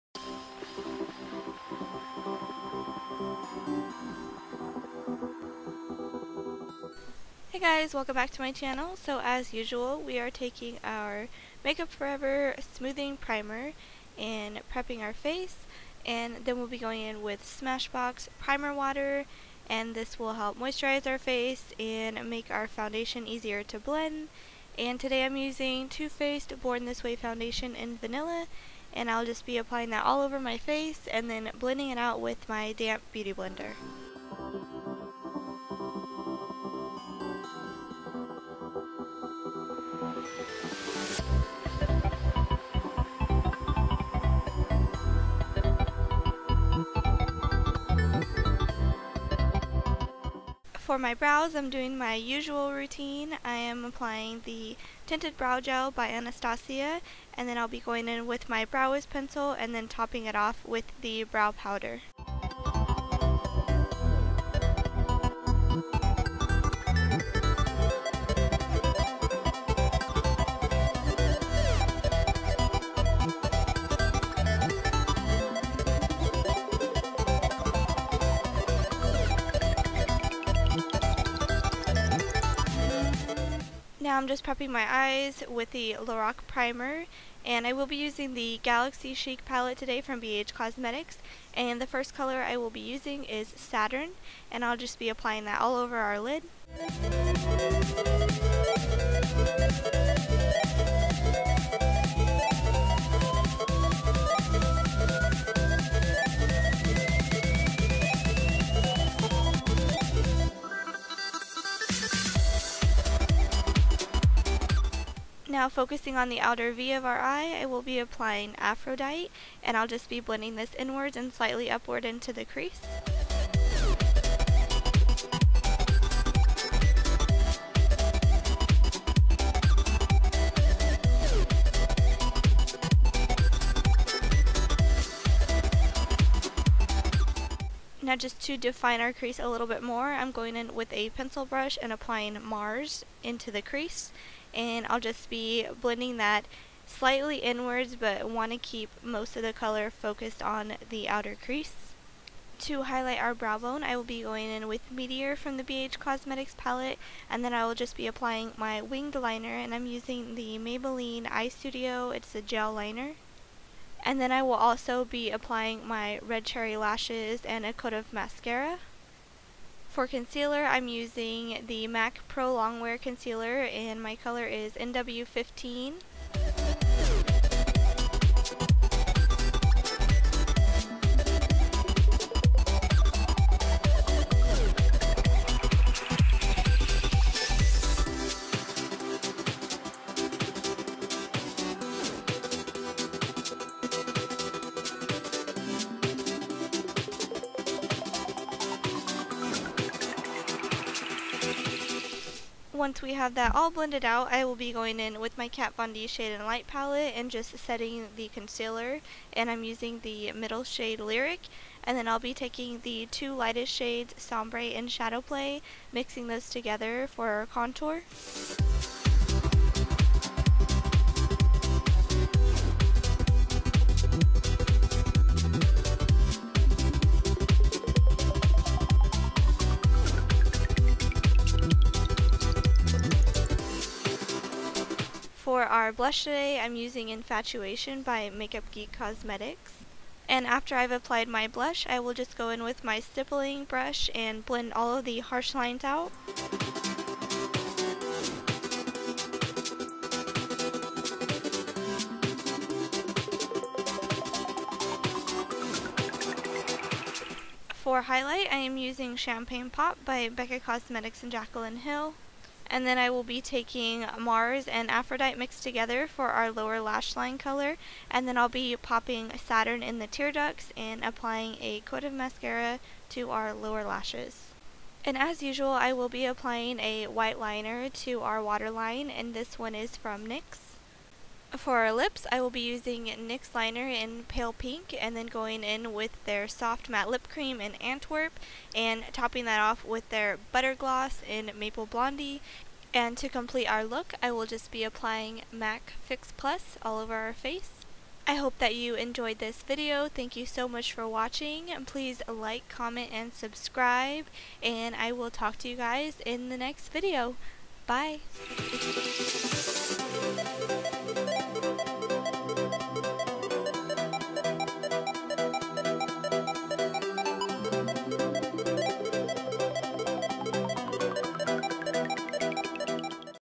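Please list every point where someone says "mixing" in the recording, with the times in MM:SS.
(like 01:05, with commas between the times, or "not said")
03:35.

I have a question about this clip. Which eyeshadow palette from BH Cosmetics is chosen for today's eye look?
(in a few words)
Galaxy Chic.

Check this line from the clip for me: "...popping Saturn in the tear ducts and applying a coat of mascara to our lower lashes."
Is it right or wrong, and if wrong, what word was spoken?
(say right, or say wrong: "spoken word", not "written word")
right.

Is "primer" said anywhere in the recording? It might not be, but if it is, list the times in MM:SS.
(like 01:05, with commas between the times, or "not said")
00:13, 00:18, 01:26.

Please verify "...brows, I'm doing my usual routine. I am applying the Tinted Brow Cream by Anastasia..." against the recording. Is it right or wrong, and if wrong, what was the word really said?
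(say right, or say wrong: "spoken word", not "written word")
wrong: "Gel", not "Cream".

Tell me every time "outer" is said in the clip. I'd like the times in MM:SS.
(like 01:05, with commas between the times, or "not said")
01:56, 02:31.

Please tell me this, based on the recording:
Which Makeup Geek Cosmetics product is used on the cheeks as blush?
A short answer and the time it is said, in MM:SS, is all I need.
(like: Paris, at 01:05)
Infatuation, at 03:57.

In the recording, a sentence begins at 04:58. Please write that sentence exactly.
I hope that you enjoyed this video.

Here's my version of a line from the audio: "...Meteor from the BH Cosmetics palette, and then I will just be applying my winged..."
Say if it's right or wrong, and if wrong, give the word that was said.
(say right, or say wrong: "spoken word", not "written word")
right.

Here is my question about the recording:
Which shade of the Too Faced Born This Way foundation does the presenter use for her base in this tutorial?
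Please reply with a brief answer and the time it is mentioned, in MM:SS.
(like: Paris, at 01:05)
Vanilla, at 00:27.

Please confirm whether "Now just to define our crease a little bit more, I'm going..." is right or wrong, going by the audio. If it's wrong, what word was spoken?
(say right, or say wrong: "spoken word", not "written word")
right.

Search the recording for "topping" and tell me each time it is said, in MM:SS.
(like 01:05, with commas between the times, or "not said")
00:59, 04:49.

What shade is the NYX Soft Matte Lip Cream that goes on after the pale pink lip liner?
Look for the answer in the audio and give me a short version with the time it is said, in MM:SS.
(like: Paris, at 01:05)
Antwerp, at 04:47.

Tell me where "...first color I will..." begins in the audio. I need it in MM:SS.
01:31.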